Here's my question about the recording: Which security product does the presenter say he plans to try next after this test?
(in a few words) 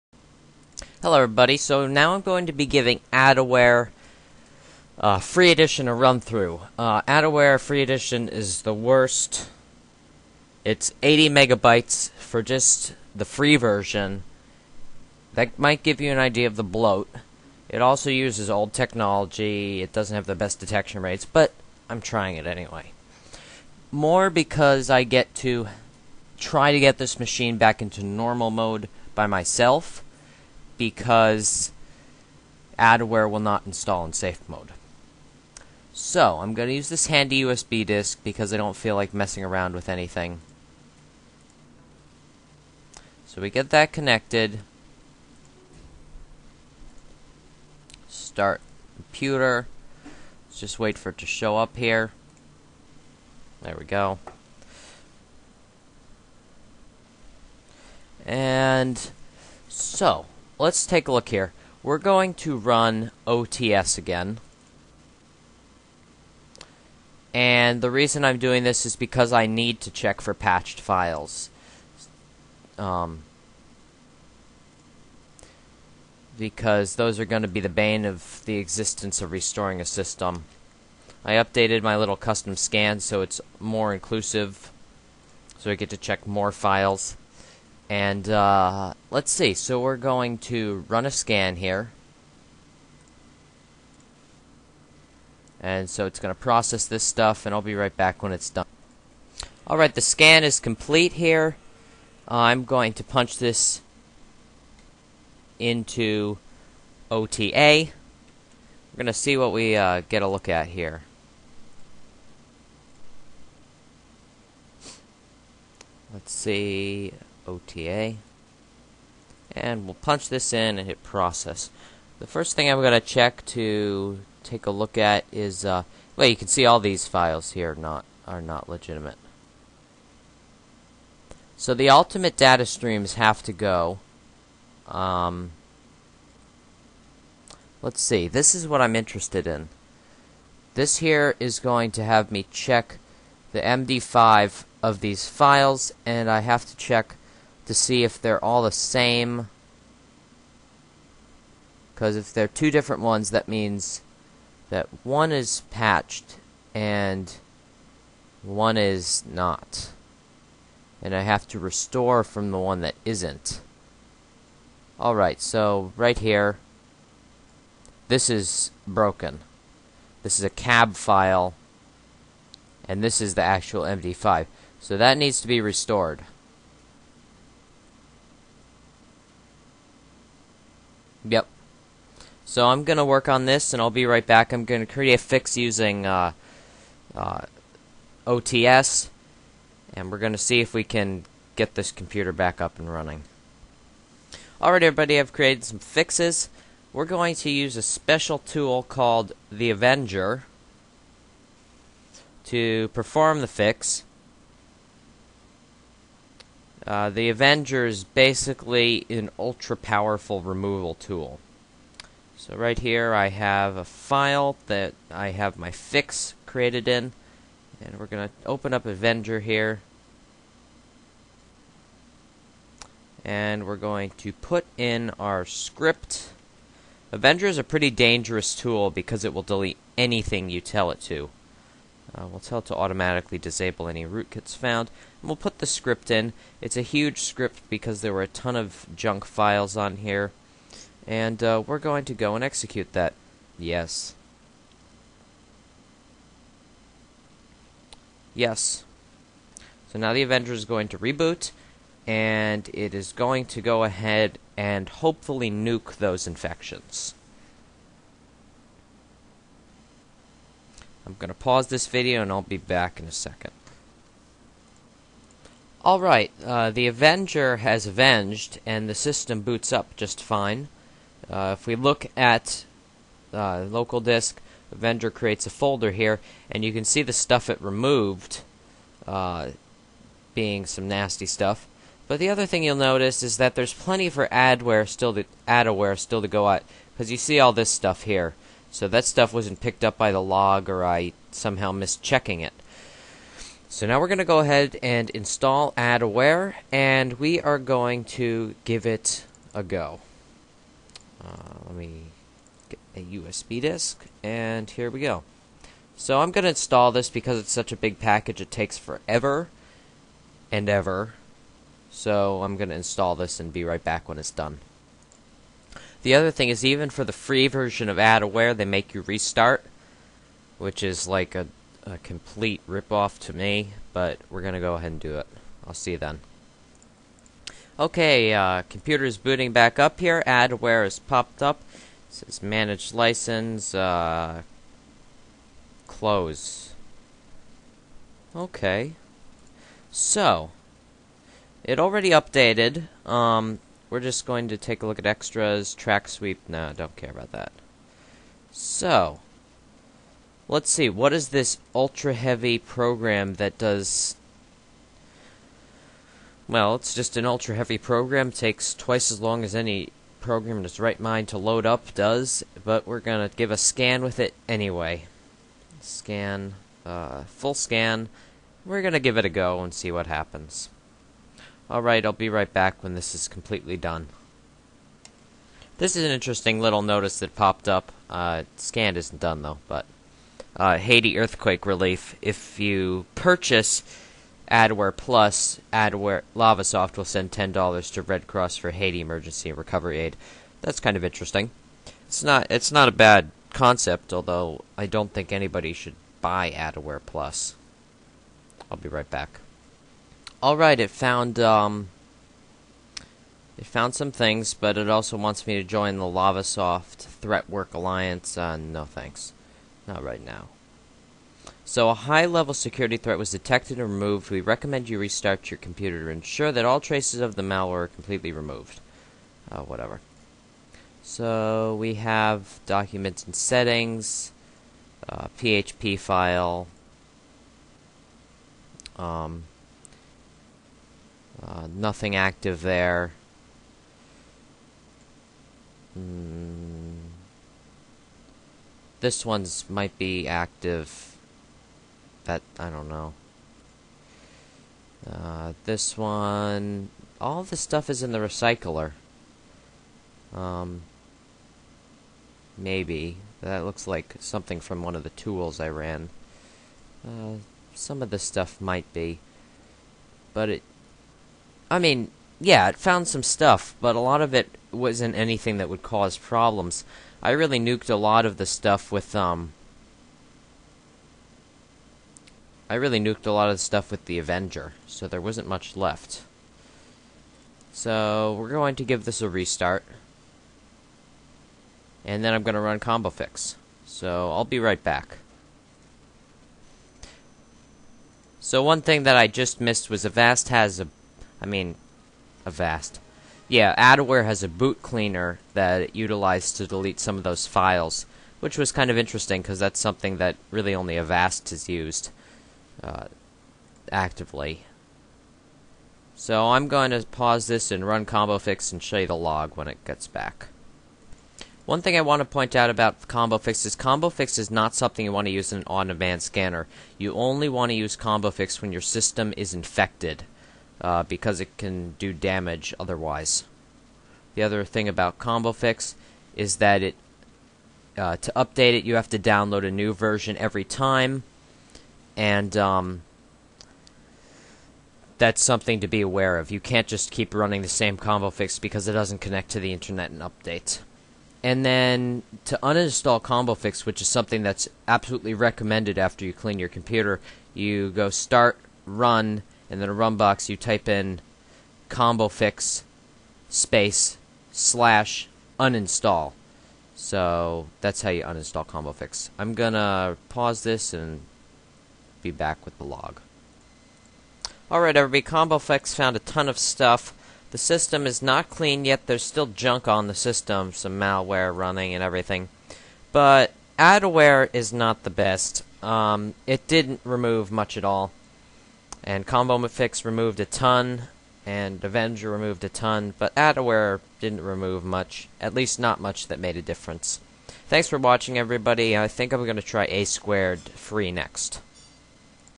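A squared free.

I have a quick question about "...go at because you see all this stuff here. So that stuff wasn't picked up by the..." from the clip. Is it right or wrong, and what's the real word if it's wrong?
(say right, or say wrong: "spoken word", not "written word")
right.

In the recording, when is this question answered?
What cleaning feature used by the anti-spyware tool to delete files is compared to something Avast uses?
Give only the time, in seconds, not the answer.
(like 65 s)
494 s.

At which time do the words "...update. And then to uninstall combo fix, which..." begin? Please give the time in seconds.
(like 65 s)
540 s.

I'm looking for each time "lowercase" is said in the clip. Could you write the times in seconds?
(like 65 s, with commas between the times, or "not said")
not said.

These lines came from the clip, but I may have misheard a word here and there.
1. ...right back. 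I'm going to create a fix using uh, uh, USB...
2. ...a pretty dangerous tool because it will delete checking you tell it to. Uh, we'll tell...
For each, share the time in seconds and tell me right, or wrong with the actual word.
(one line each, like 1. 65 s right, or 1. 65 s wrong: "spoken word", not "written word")
1. 184 s wrong: "OTS", not "USB"
2. 227 s wrong: "anything", not "checking".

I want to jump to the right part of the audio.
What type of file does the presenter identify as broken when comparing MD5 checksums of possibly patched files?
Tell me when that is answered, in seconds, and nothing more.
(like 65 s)
170 s.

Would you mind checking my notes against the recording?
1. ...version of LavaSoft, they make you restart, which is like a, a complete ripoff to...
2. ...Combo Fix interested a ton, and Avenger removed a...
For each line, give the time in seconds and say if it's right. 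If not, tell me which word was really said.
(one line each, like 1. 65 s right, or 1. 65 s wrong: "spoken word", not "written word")
1. 317 s wrong: "AdAware", not "LavaSoft"
2. 579 s wrong: "removed", not "interested".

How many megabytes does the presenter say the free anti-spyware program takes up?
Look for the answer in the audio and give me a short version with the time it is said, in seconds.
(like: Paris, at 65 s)
80, at 11 s.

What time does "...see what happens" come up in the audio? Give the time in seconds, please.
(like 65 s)
369 s.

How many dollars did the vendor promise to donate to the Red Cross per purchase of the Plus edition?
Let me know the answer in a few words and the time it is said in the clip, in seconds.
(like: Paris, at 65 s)
10, at 387 s.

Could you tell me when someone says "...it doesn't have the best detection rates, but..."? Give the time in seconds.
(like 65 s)
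19 s.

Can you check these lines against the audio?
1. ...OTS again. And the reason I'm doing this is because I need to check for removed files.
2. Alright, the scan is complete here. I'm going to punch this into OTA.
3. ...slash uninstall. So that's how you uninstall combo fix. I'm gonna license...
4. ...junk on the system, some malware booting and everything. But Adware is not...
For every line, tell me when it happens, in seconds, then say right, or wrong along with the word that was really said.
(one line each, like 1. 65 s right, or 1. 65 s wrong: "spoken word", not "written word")
1. 63 s wrong: "patched", not "removed"
2. 99 s right
3. 554 s wrong: "pause", not "license"
4. 569 s wrong: "running", not "booting".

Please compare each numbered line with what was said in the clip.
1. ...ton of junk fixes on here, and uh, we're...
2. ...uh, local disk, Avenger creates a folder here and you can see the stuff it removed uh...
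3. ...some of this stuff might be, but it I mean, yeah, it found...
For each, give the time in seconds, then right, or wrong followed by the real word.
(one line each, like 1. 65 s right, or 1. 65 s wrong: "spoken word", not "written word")
1. 238 s wrong: "files", not "fixes"
2. 273 s right
3. 457 s right.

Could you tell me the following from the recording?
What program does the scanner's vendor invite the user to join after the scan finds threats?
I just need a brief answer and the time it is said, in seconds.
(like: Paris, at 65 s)
LavaSoft Threat Work Alliance, at 406 s.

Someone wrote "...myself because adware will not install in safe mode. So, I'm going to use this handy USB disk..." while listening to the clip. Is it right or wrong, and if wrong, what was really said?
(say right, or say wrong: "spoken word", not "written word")
right.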